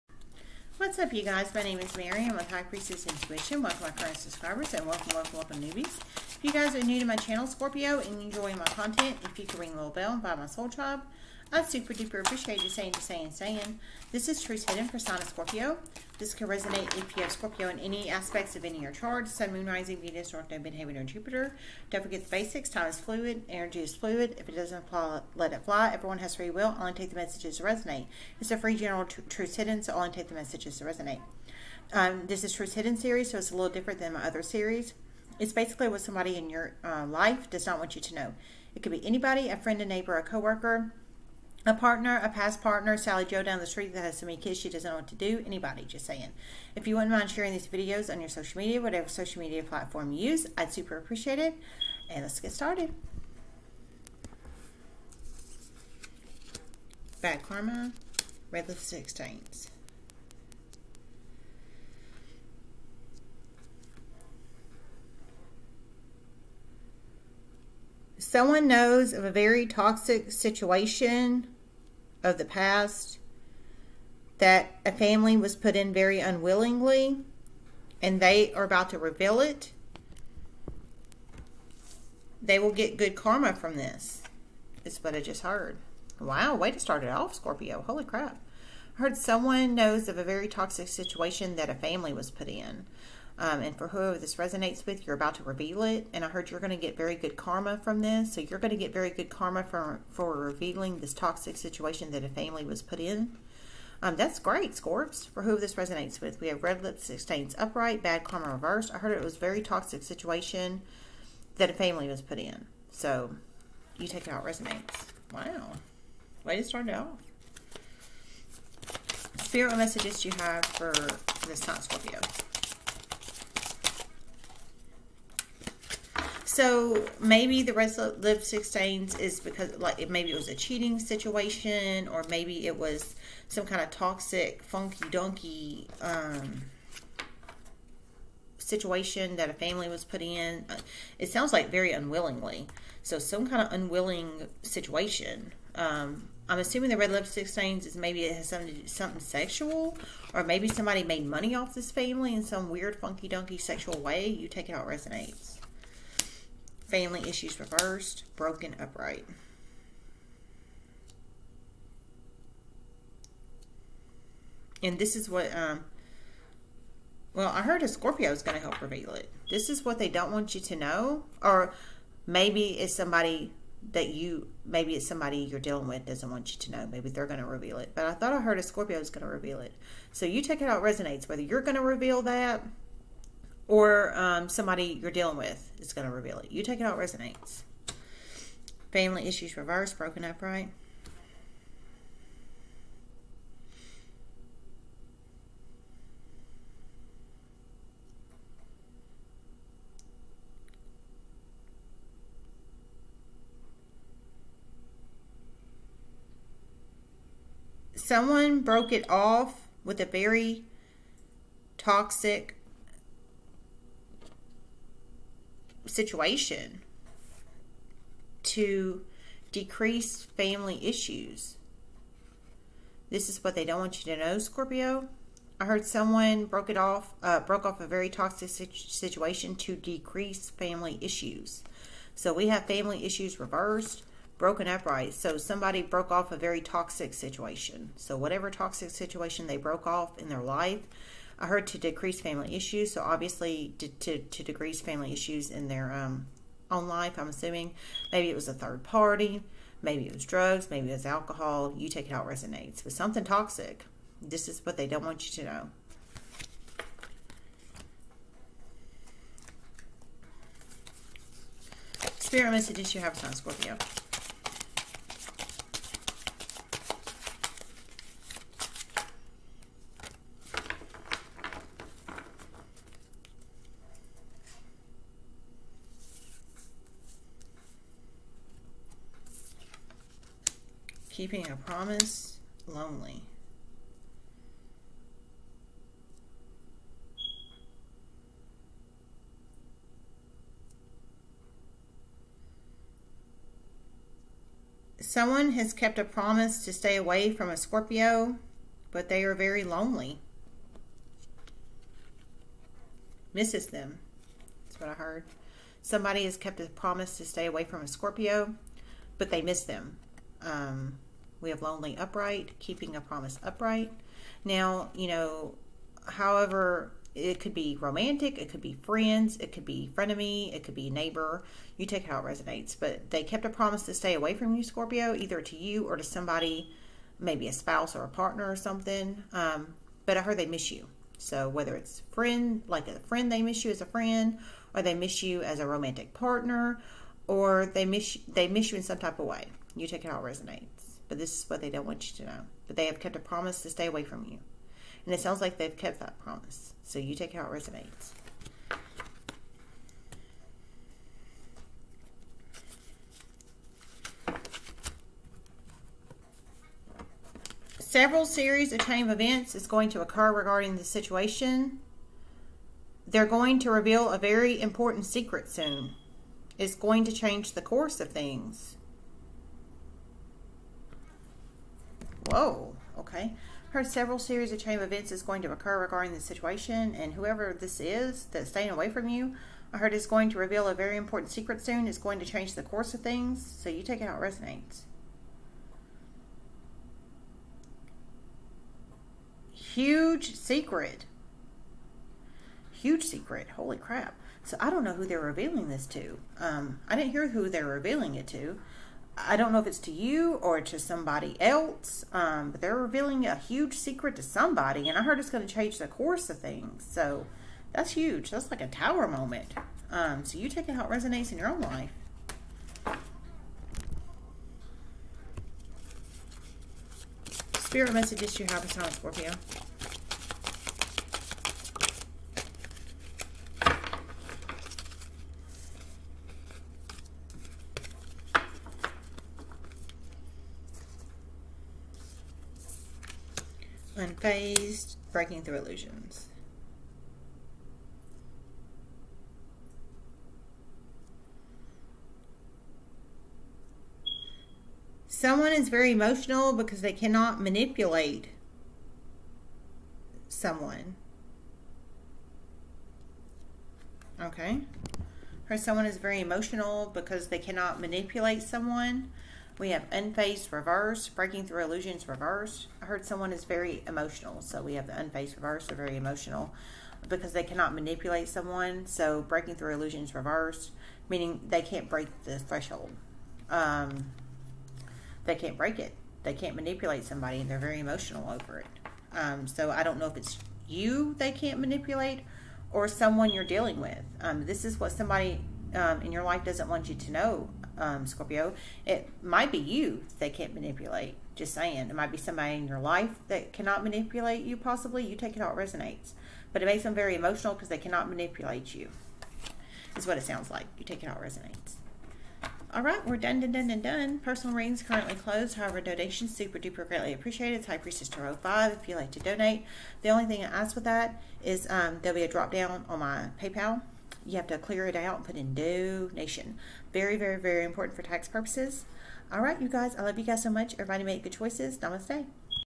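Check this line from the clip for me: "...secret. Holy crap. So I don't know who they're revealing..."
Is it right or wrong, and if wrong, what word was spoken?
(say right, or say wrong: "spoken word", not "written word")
right.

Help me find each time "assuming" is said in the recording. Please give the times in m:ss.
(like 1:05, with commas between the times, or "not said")
2:26, 4:07.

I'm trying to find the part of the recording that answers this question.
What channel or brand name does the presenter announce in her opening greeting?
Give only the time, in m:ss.
0:02.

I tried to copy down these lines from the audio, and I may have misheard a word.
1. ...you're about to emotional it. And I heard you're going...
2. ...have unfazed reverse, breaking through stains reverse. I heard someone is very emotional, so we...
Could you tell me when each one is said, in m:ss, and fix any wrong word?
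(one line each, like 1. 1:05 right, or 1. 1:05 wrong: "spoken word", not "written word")
1. 1:35 wrong: "reveal", not "emotional"
2. 7:39 wrong: "illusions", not "stains".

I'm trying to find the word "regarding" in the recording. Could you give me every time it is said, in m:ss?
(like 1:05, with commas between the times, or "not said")
6:00, 6:15.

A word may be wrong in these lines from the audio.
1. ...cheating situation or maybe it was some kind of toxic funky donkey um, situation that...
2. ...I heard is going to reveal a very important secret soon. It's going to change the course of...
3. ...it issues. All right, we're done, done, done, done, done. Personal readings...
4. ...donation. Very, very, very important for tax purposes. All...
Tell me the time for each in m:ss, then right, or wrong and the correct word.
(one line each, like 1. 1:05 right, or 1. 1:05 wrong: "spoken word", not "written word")
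1. 2:10 right
2. 6:19 right
3. 8:21 wrong: "resonates", not "issues"
4. 8:35 right.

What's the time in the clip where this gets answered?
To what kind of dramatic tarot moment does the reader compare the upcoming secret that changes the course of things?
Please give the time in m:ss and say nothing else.
6:48.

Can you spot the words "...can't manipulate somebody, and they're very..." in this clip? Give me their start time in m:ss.
7:56.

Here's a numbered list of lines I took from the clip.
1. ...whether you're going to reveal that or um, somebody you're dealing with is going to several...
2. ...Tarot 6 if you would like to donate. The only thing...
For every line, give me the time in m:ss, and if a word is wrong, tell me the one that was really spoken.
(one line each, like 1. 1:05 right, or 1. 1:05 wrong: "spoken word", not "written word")
1. 3:01 wrong: "reveal", not "several"
2. 8:28 wrong: "5", not "6".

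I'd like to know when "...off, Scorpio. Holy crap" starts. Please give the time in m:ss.
1:27.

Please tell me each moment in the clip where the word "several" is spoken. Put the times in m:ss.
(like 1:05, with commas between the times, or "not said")
5:57, 6:13.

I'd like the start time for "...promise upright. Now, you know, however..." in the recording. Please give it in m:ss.
5:13.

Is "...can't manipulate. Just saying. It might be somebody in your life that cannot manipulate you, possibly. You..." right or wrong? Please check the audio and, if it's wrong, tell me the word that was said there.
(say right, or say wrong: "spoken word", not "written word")
right.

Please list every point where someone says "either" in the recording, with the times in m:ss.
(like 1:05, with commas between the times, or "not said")
5:25.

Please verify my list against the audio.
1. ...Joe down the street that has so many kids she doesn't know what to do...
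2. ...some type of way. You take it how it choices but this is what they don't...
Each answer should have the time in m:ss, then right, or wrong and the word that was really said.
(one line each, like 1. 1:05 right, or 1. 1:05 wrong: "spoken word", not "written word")
1. 0:43 right
2. 5:38 wrong: "resonates", not "choices".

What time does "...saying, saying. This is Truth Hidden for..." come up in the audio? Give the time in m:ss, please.
0:12.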